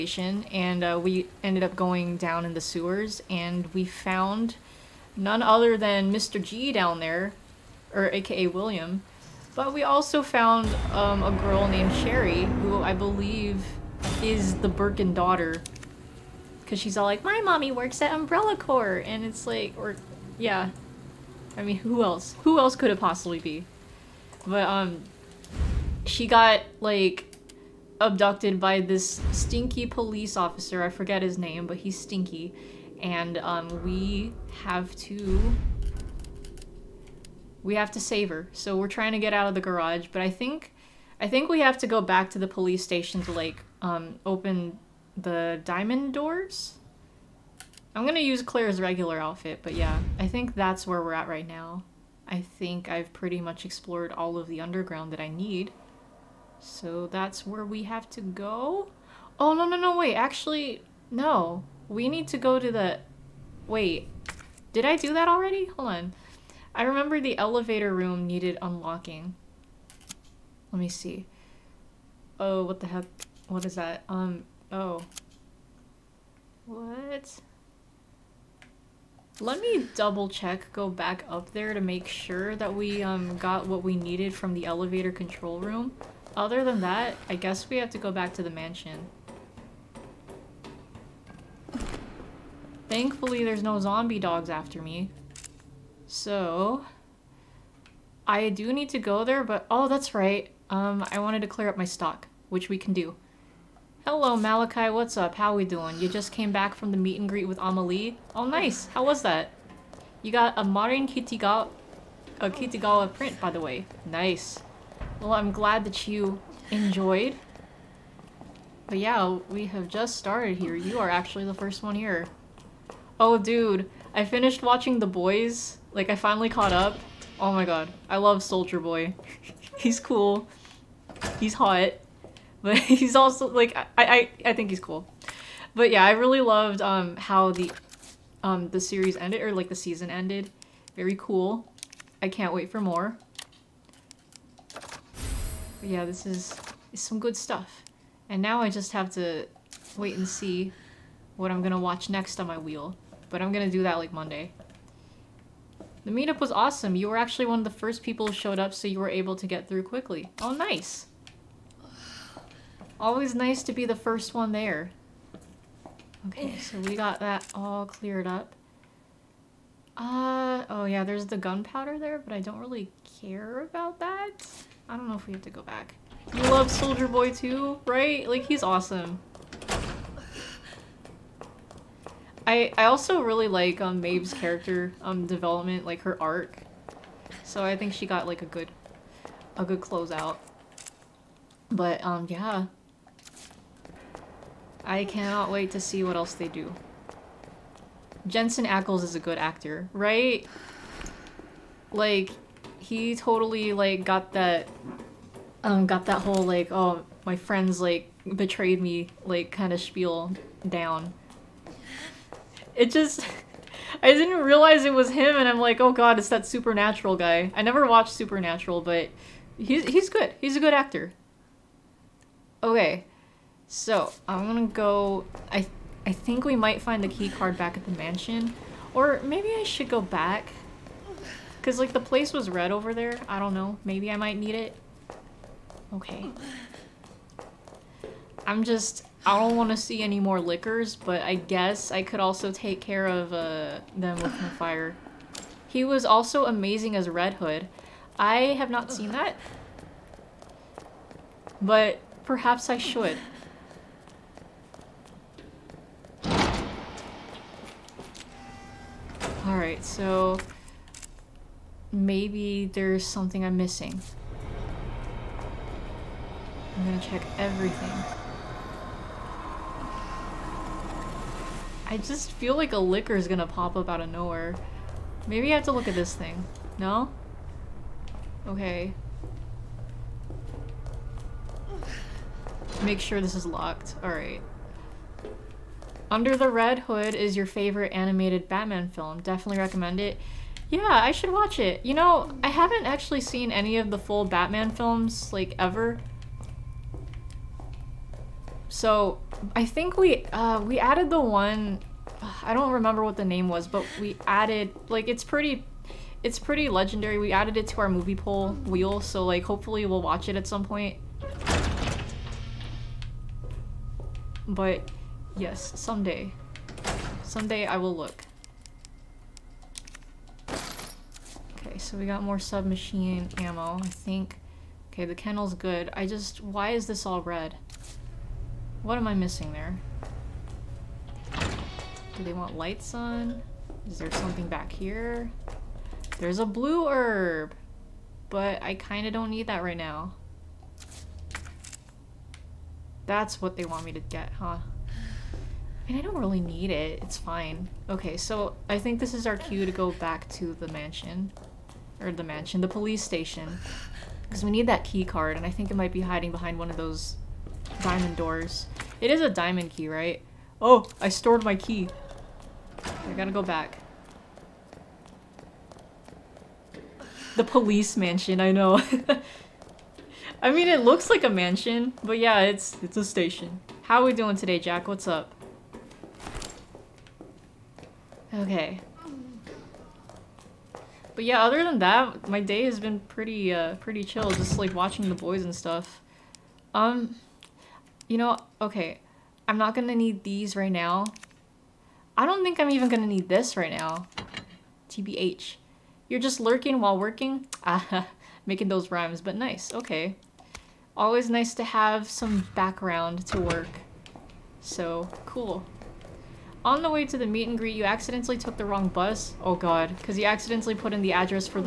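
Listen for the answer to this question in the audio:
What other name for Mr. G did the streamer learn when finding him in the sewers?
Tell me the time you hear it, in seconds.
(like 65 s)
8 s.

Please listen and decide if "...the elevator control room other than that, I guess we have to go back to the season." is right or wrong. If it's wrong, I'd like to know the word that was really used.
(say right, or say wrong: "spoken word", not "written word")
wrong: "mansion", not "season".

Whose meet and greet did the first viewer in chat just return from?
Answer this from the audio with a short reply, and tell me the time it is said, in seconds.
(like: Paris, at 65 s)
AmaLee, at 107 s.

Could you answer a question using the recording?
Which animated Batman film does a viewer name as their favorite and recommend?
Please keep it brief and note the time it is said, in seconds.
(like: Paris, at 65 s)
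Under the Red Hood, at 286 s.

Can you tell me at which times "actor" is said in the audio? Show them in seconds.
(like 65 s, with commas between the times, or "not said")
199 s, 220 s.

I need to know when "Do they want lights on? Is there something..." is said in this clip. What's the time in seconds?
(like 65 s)
332 s.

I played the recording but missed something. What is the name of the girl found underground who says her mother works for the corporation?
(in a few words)
Sherry.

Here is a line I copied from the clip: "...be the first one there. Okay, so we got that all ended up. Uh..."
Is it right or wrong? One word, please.
wrong.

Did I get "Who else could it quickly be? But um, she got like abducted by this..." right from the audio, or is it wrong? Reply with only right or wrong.
wrong.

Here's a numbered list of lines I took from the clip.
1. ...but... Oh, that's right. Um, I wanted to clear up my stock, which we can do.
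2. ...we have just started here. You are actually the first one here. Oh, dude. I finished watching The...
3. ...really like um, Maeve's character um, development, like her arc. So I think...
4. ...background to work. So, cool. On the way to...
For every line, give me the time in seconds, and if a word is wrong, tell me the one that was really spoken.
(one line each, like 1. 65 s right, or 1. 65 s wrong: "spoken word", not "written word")
1. 99 s right
2. 119 s right
3. 183 s right
4. 402 s right.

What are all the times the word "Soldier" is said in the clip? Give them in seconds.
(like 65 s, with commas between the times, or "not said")
128 s, 176 s.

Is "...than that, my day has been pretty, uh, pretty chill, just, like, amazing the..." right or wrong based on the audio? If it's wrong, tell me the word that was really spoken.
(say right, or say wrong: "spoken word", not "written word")
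wrong: "watching", not "amazing".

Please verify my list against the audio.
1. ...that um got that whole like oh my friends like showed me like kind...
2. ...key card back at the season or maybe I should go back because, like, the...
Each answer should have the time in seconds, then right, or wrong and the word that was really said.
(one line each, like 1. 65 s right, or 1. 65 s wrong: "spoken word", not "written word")
1. 204 s wrong: "betrayed", not "showed"
2. 227 s wrong: "mansion", not "season".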